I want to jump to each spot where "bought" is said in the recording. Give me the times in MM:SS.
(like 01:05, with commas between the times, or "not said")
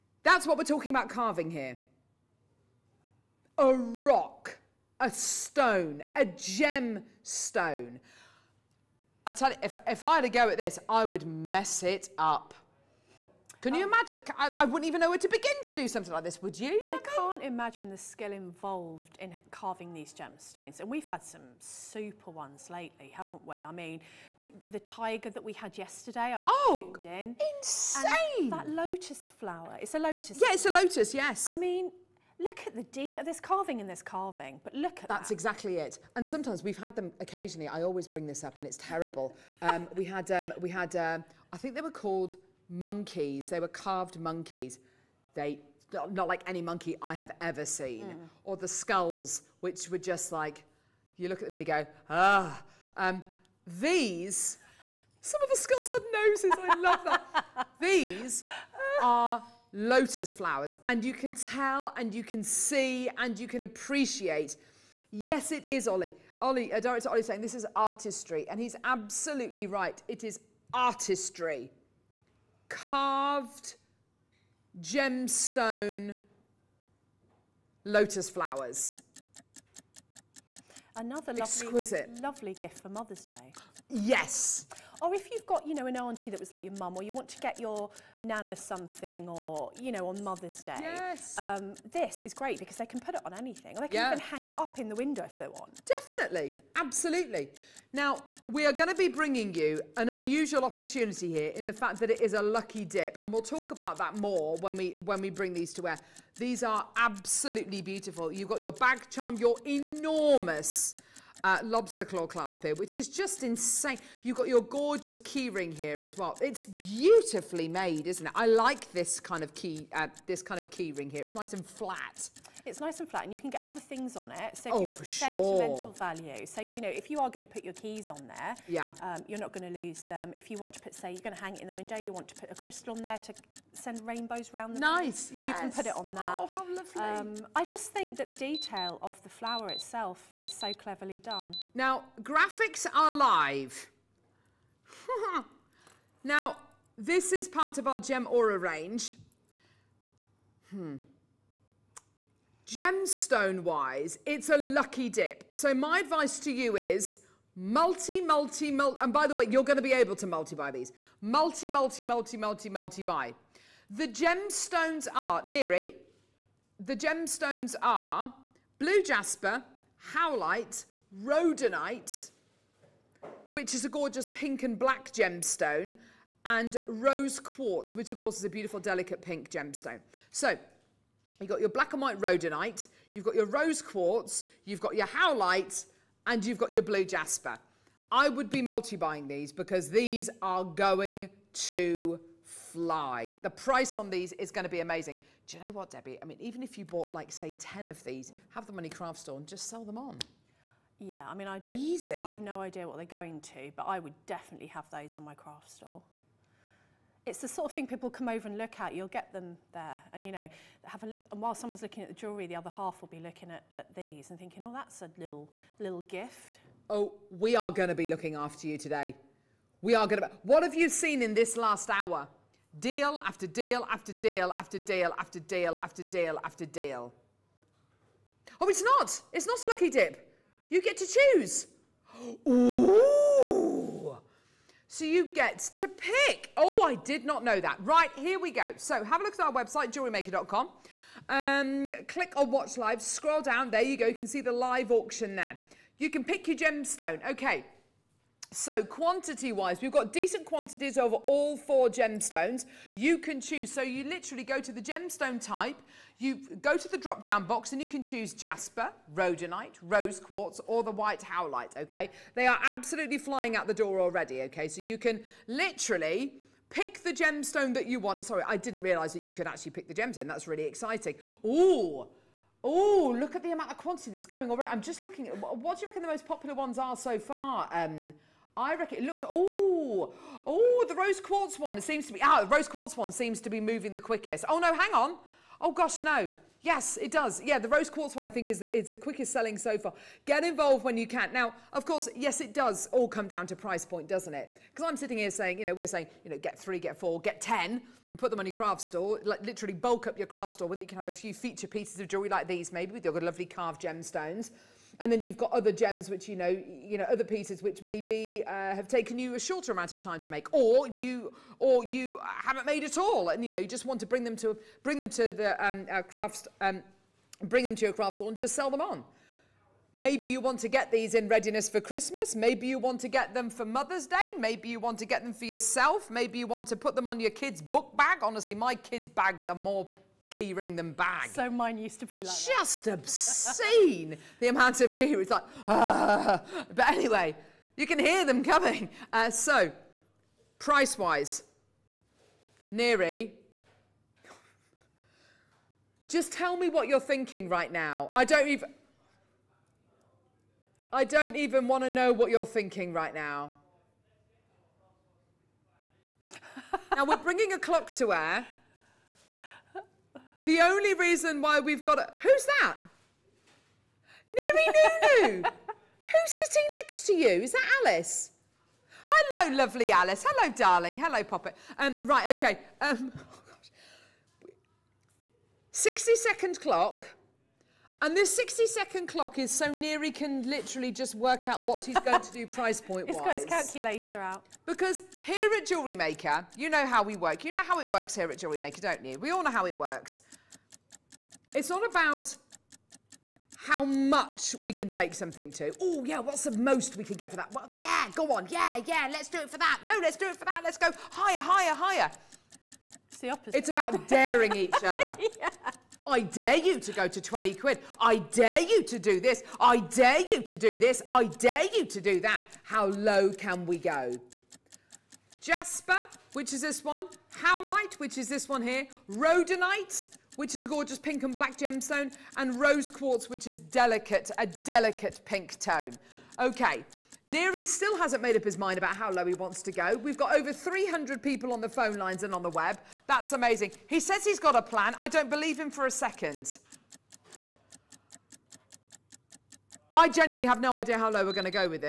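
03:16.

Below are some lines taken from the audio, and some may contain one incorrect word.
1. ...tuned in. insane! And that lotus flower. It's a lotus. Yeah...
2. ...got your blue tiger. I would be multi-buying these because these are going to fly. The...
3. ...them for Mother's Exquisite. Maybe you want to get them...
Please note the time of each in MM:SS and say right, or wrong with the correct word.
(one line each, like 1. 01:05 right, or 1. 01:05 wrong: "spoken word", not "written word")
1. 00:27 right
2. 03:06 wrong: "jasper", not "tiger"
3. 05:23 wrong: "Day", not "Exquisite".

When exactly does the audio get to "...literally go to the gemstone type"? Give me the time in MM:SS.
04:14.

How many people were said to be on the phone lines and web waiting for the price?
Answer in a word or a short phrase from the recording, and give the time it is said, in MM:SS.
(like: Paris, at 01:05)
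Over 300, at 07:10.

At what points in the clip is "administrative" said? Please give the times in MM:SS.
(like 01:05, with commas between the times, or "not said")
not said.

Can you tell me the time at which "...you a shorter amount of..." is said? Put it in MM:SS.
05:09.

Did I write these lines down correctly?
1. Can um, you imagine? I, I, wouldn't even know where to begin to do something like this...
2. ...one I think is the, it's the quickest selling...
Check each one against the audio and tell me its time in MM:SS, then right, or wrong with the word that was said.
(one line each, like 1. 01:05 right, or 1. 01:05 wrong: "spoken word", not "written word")
1. 00:13 right
2. 04:48 right.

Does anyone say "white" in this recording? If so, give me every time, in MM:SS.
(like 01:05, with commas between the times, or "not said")
03:02, 04:20.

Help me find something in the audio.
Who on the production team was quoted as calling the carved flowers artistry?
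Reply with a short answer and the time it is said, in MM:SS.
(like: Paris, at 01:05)
Director Ollie, at 01:06.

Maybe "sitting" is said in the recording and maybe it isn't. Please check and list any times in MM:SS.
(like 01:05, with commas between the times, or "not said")
04:54, 06:06.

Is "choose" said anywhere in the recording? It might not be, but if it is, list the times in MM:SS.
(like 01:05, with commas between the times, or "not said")
03:51, 04:13, 04:18.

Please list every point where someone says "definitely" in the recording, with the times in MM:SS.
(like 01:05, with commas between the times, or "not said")
01:35, 03:24.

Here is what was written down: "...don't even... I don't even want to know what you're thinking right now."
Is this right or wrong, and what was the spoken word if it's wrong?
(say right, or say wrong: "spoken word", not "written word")
right.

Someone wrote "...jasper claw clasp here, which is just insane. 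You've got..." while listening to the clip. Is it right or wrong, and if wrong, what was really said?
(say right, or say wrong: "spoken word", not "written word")
wrong: "lobster", not "jasper".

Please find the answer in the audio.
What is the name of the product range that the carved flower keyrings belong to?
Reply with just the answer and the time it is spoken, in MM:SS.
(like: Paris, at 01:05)
Gem Aura, at 02:27.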